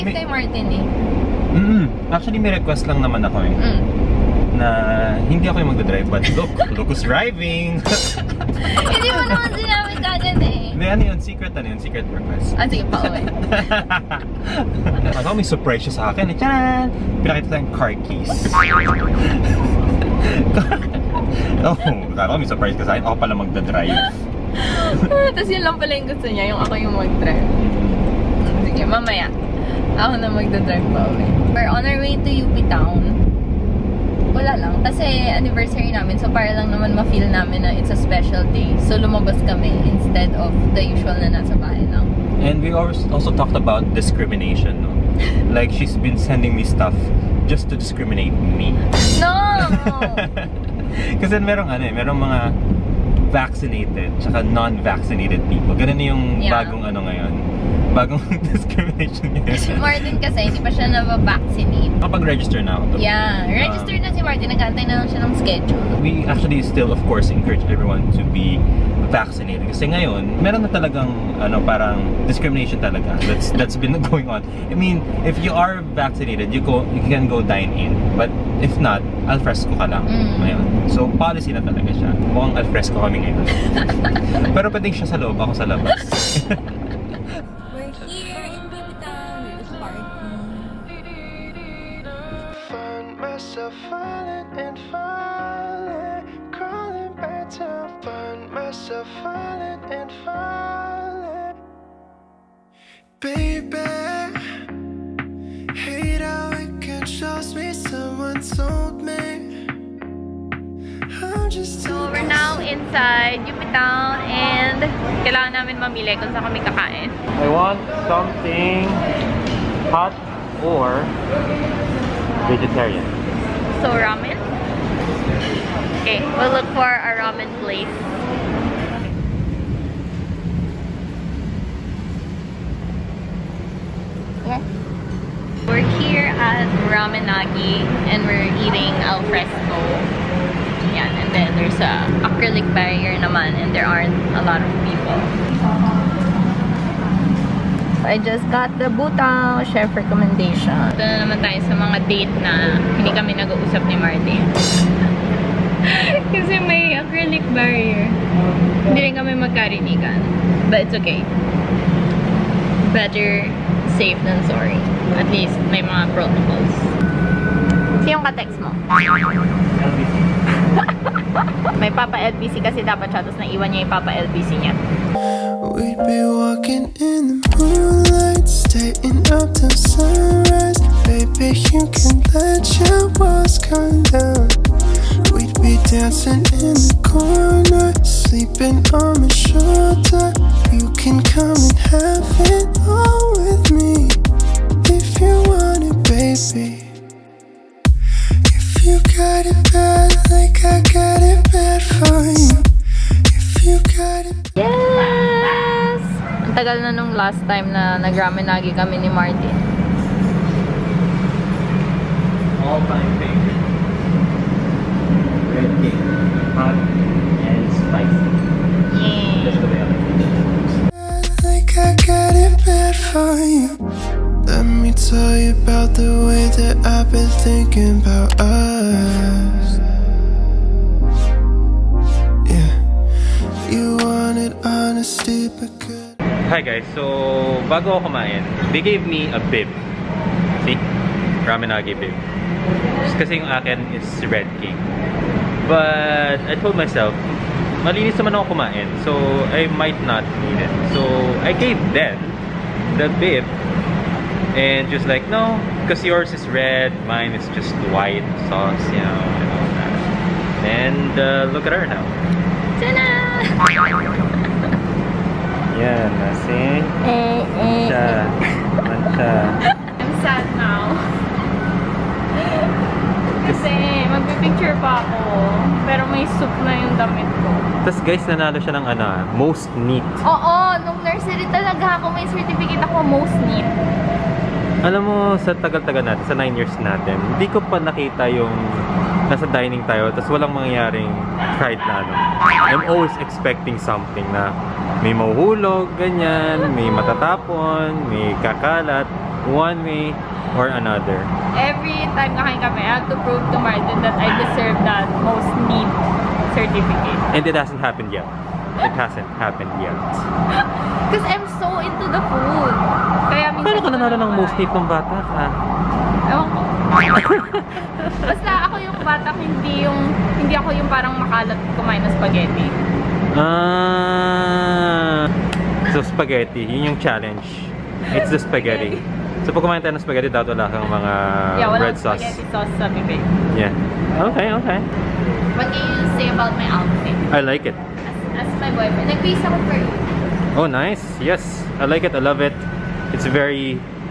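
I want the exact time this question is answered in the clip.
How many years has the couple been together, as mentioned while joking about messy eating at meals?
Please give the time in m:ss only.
4:46.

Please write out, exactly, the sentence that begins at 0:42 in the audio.
And we also talked about discrimination, no?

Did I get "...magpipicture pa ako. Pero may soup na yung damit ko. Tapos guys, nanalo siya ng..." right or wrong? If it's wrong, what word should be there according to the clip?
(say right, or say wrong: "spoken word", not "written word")
right.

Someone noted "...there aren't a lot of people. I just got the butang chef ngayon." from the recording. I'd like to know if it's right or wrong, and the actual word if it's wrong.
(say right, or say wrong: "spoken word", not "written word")
wrong: "recommendation", not "ngayon".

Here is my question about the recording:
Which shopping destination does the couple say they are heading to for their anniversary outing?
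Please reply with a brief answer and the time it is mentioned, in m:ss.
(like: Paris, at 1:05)
UP Town, at 0:32.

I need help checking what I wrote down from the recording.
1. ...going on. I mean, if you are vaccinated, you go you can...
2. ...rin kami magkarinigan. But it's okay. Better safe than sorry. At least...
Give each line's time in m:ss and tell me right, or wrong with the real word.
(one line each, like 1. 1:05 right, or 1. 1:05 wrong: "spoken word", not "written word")
1. 1:14 right
2. 2:39 right.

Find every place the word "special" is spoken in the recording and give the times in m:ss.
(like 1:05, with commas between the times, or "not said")
0:37.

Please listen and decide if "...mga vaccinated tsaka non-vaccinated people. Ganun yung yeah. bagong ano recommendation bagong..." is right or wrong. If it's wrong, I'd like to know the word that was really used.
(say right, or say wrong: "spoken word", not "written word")
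wrong: "ngayon", not "recommendation".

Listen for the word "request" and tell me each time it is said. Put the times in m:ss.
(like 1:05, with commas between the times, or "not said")
0:02, 0:12.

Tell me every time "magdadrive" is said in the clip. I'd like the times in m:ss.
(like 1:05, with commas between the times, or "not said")
0:05, 0:23, 0:30.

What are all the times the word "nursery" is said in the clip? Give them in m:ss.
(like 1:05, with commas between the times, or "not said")
4:41.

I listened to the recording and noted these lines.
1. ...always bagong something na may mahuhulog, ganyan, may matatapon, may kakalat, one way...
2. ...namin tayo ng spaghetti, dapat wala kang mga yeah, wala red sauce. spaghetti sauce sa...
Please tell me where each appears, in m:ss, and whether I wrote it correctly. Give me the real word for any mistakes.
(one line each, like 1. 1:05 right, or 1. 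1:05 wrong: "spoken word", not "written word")
1. 4:52 wrong: "expecting", not "bagong"
2. 5:29 wrong: "kumain", not "namin".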